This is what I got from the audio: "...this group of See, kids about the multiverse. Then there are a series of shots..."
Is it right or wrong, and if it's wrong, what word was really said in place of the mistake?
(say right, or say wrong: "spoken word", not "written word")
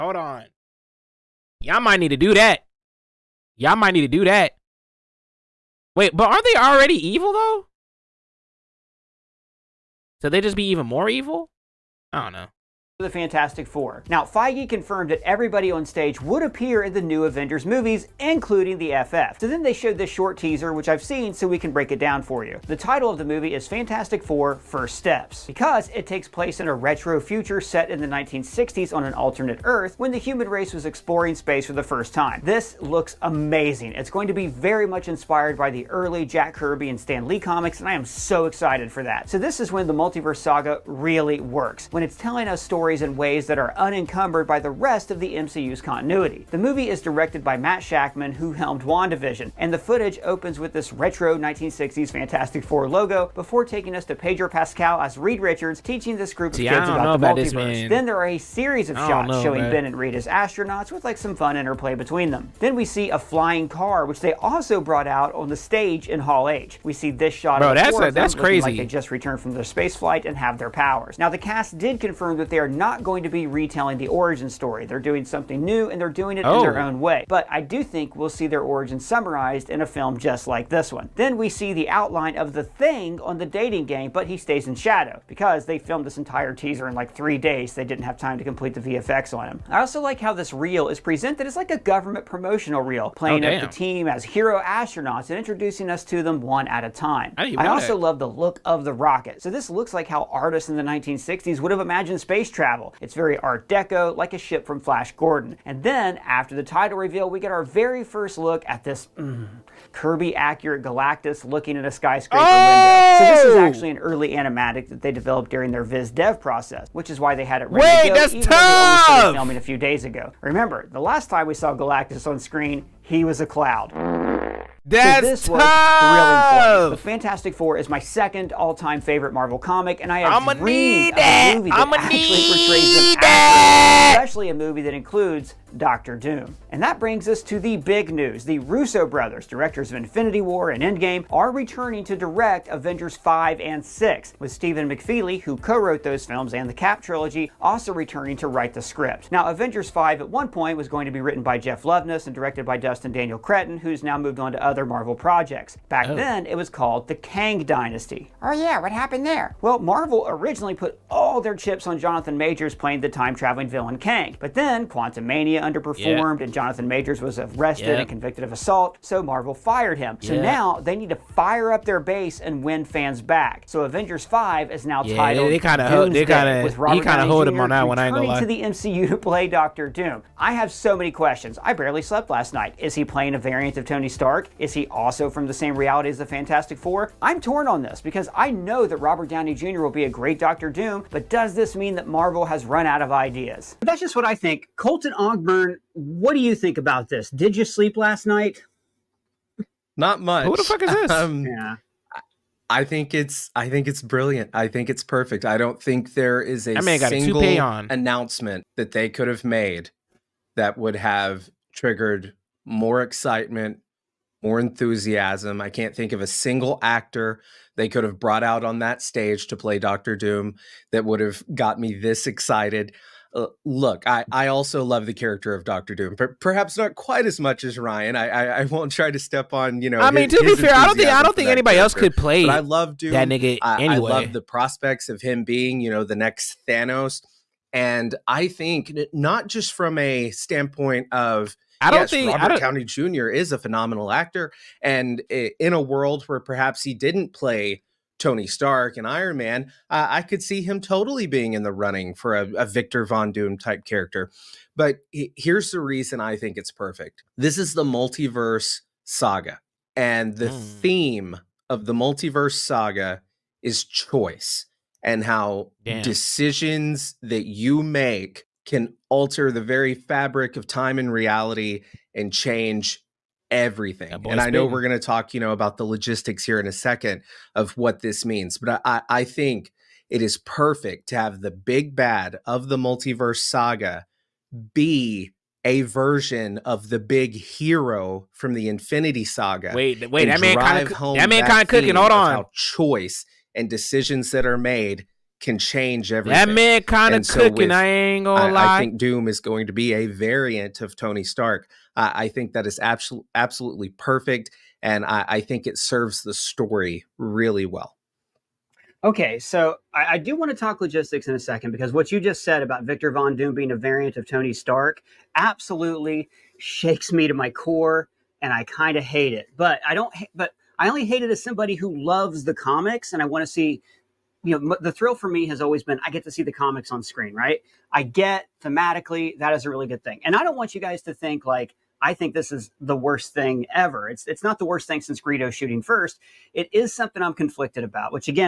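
right.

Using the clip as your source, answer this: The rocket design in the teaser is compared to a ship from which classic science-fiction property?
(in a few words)
Flash Gordon.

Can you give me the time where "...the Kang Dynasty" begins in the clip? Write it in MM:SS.
02:37.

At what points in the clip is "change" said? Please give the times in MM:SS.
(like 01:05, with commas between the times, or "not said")
04:32, 04:55.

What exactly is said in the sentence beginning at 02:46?
and Jonathan Majors was arrested yeah.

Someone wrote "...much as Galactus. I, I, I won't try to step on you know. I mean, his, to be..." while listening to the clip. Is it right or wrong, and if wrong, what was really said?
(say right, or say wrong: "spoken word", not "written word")
wrong: "Ryan", not "Galactus".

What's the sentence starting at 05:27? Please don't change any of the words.
I get thematically that is a really good thing.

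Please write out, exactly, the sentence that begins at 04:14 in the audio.
But he, here's the reason I think it's perfect this is the multiverse saga, and the mm.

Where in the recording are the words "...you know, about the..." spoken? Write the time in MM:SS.
04:35.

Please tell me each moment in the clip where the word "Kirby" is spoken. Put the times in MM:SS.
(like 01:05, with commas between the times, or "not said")
00:36, 01:49.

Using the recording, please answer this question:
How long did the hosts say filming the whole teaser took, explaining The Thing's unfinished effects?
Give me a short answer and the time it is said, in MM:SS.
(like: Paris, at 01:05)
3 days, at 01:27.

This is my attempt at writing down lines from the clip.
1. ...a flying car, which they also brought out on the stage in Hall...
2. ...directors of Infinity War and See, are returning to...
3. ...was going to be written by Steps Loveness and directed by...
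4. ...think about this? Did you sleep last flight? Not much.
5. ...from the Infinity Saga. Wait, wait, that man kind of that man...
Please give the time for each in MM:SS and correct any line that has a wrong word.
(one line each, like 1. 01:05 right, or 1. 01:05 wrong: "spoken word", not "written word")
1. 01:03 right
2. 02:19 wrong: "Endgame", not "See"
3. 02:30 wrong: "Jeff", not "Steps"
4. 03:16 wrong: "night", not "flight"
5. 04:48 right.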